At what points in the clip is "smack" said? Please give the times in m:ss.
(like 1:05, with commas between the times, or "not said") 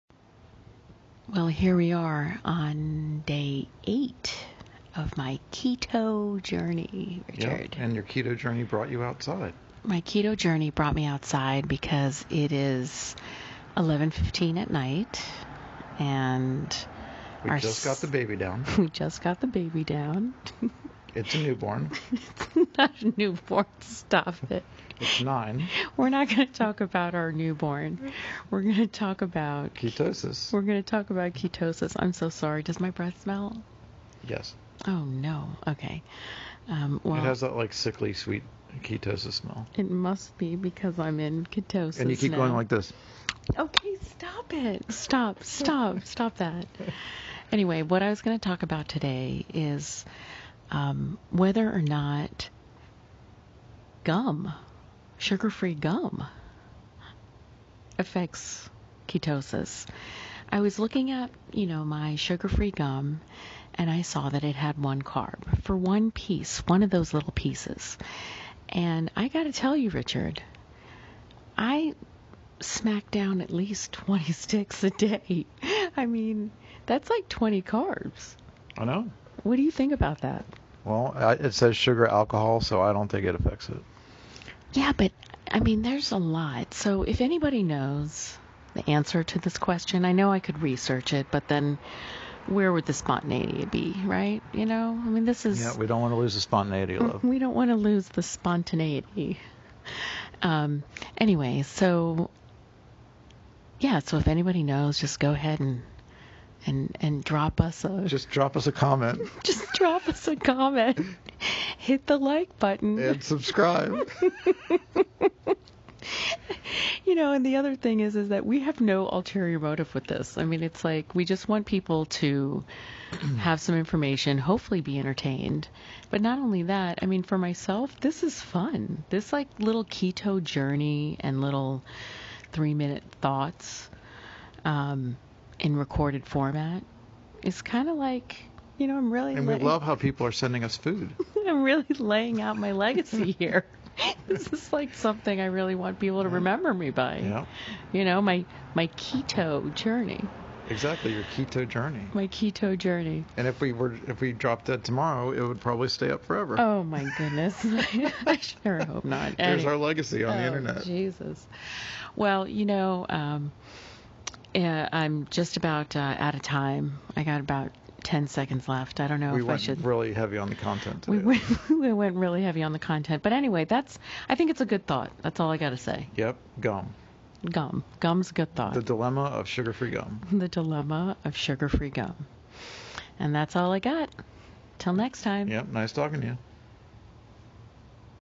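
1:12.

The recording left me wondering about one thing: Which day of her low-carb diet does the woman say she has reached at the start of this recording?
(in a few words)
Day 8.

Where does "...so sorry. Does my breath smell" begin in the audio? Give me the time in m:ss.
0:32.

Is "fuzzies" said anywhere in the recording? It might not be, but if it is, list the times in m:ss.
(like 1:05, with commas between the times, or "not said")
not said.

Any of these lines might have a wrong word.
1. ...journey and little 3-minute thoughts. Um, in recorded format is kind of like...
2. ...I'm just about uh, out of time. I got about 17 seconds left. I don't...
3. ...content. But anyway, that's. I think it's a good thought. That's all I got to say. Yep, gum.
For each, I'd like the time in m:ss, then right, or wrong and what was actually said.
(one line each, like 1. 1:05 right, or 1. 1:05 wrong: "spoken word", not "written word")
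1. 2:10 right
2. 2:44 wrong: "10", not "17"
3. 2:52 right.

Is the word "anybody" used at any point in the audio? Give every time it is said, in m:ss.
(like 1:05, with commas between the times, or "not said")
1:27, 1:44.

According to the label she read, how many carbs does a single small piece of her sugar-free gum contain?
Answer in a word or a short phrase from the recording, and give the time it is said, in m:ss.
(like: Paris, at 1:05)
1 carb, at 1:04.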